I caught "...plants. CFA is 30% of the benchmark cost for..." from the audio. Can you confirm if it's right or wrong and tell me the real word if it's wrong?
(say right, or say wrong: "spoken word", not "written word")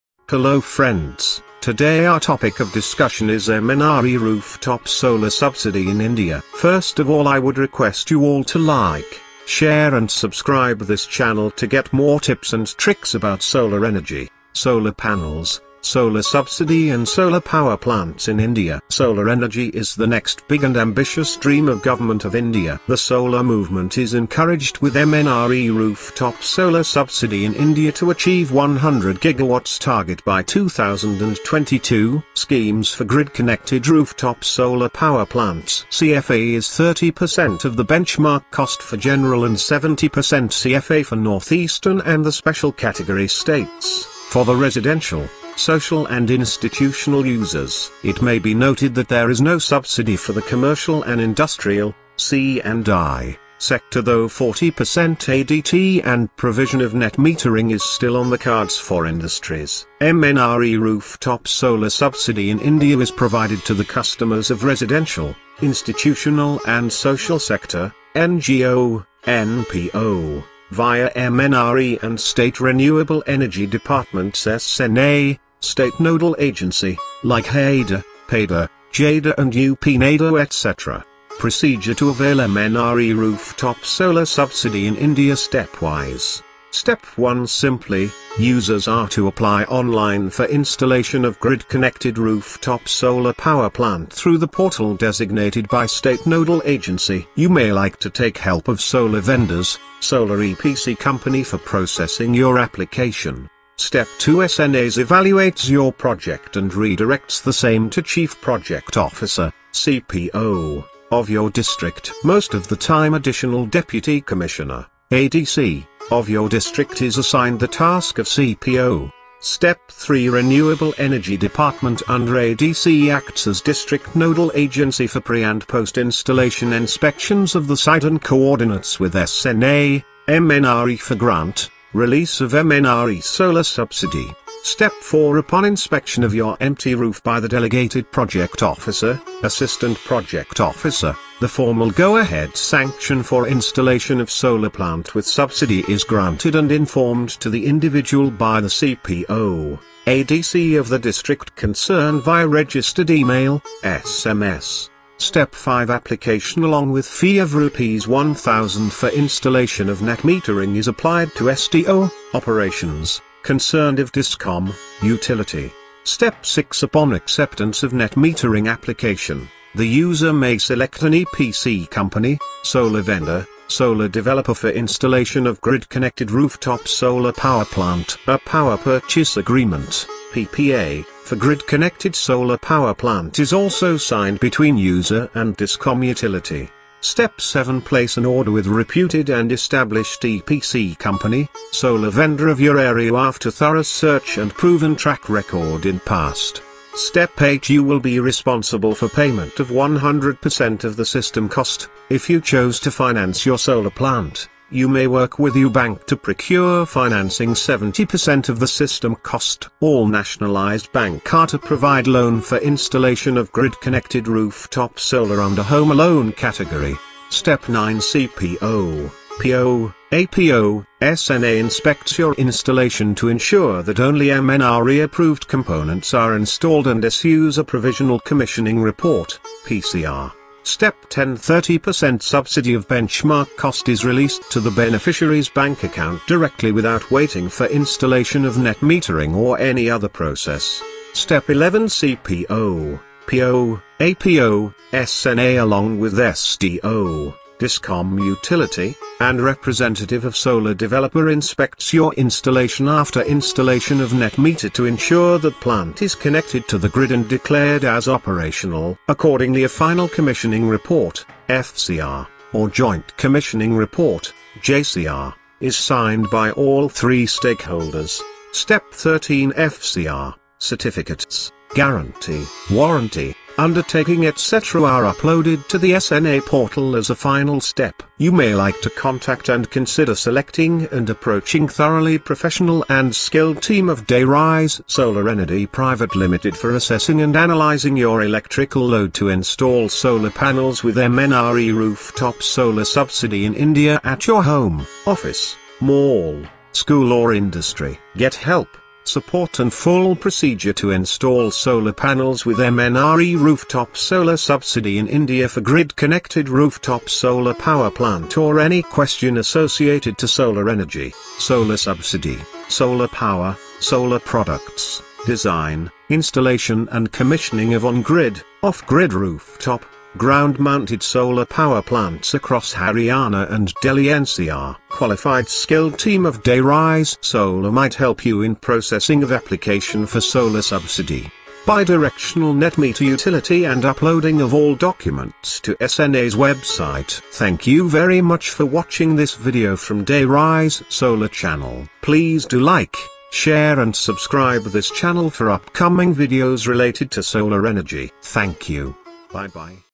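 right.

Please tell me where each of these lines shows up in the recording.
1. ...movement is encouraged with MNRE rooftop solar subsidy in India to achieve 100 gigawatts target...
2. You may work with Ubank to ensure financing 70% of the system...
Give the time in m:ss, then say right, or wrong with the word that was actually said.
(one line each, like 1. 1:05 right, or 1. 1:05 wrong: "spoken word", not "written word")
1. 0:23 right
2. 3:24 wrong: "procure", not "ensure".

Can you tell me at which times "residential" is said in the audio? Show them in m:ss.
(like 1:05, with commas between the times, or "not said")
0:44, 1:04.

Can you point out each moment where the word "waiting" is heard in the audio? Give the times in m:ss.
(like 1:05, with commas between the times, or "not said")
3:57.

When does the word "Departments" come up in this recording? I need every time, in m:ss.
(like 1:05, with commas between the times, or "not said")
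1:13, 2:01.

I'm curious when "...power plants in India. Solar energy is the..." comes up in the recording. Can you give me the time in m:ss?
0:17.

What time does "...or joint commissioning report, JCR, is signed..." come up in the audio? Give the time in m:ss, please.
4:22.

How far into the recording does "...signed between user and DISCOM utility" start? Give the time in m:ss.
3:03.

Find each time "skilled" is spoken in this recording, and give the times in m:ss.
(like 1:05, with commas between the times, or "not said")
4:43, 5:25.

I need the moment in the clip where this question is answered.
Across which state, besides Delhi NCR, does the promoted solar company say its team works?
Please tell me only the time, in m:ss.
5:22.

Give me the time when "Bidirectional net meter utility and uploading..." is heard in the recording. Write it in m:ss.
5:31.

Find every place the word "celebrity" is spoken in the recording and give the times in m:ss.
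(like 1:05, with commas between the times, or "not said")
not said.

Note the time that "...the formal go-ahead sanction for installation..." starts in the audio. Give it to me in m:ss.
2:21.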